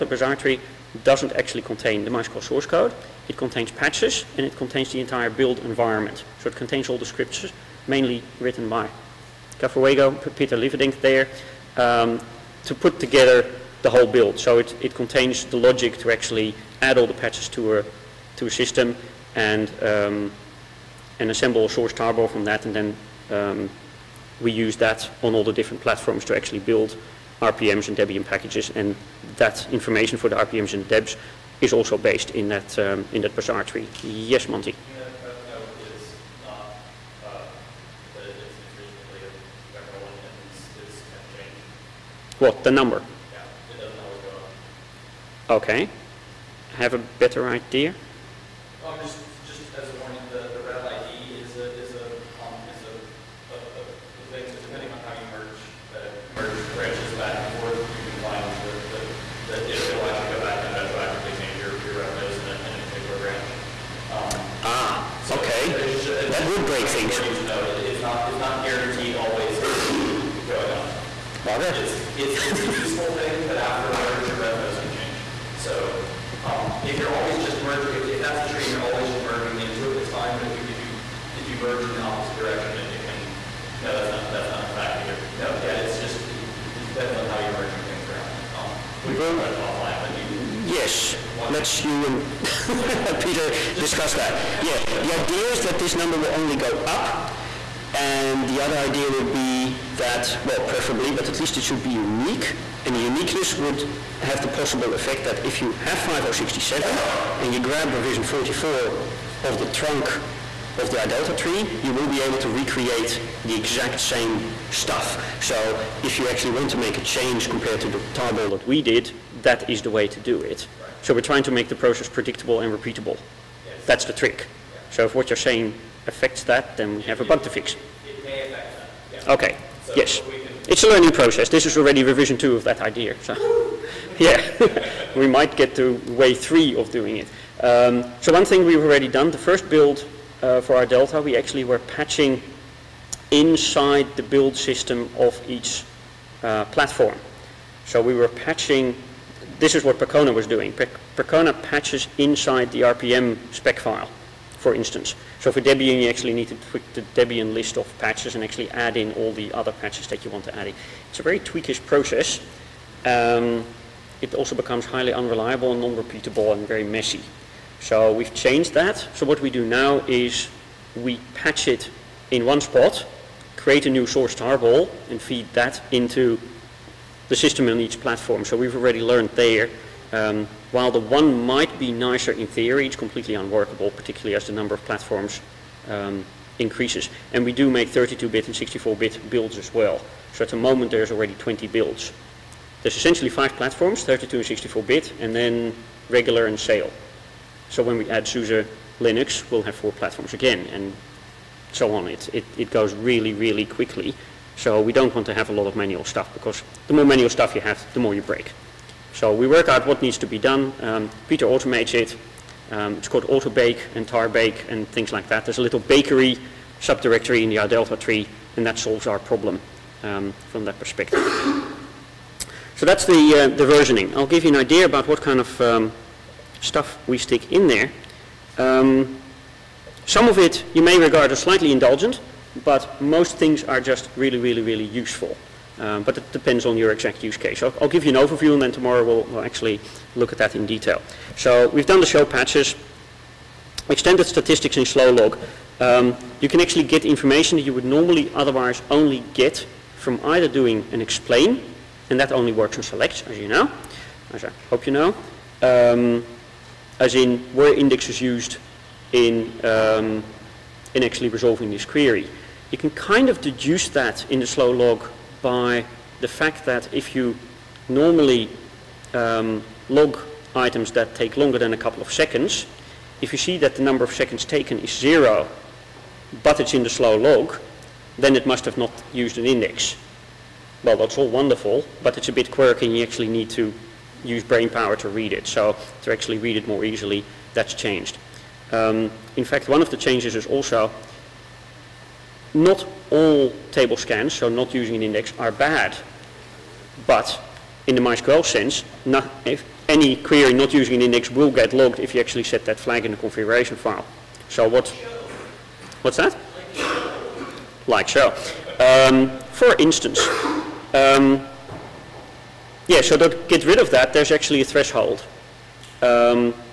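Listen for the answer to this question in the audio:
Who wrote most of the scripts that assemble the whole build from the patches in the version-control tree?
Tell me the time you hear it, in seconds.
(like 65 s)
10 s.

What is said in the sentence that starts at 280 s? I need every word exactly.
Well, that's all wonderful, but it's a bit quirky and you actually need to use brain power to read it.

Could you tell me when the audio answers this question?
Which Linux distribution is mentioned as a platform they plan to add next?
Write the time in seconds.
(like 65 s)
198 s.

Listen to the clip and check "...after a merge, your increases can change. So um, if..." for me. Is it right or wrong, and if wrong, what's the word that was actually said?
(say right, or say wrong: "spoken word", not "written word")
wrong: "revenues", not "increases".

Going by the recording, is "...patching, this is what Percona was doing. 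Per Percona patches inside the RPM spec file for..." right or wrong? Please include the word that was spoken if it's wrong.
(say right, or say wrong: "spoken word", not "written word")
right.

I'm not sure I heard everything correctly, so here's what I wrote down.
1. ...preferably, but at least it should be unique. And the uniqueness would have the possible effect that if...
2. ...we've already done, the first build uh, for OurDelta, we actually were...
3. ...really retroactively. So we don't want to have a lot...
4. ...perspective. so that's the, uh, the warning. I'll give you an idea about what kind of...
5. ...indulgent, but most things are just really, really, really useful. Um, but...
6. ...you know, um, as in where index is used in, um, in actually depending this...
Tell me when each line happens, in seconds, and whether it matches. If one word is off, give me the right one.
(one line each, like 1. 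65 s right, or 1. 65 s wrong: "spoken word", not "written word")
1. 100 s right
2. 138 s right
3. 203 s wrong: "quickly", not "retroactively"
4. 220 s wrong: "versioning", not "warning"
5. 231 s right
6. 254 s wrong: "resolving", not "depending".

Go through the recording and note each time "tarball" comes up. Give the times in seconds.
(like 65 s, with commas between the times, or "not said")
21 s, 118 s, 174 s.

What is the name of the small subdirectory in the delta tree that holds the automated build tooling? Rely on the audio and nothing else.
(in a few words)
bakery.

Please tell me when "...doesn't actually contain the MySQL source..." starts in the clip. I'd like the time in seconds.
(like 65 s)
1 s.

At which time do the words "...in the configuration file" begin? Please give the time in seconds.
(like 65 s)
303 s.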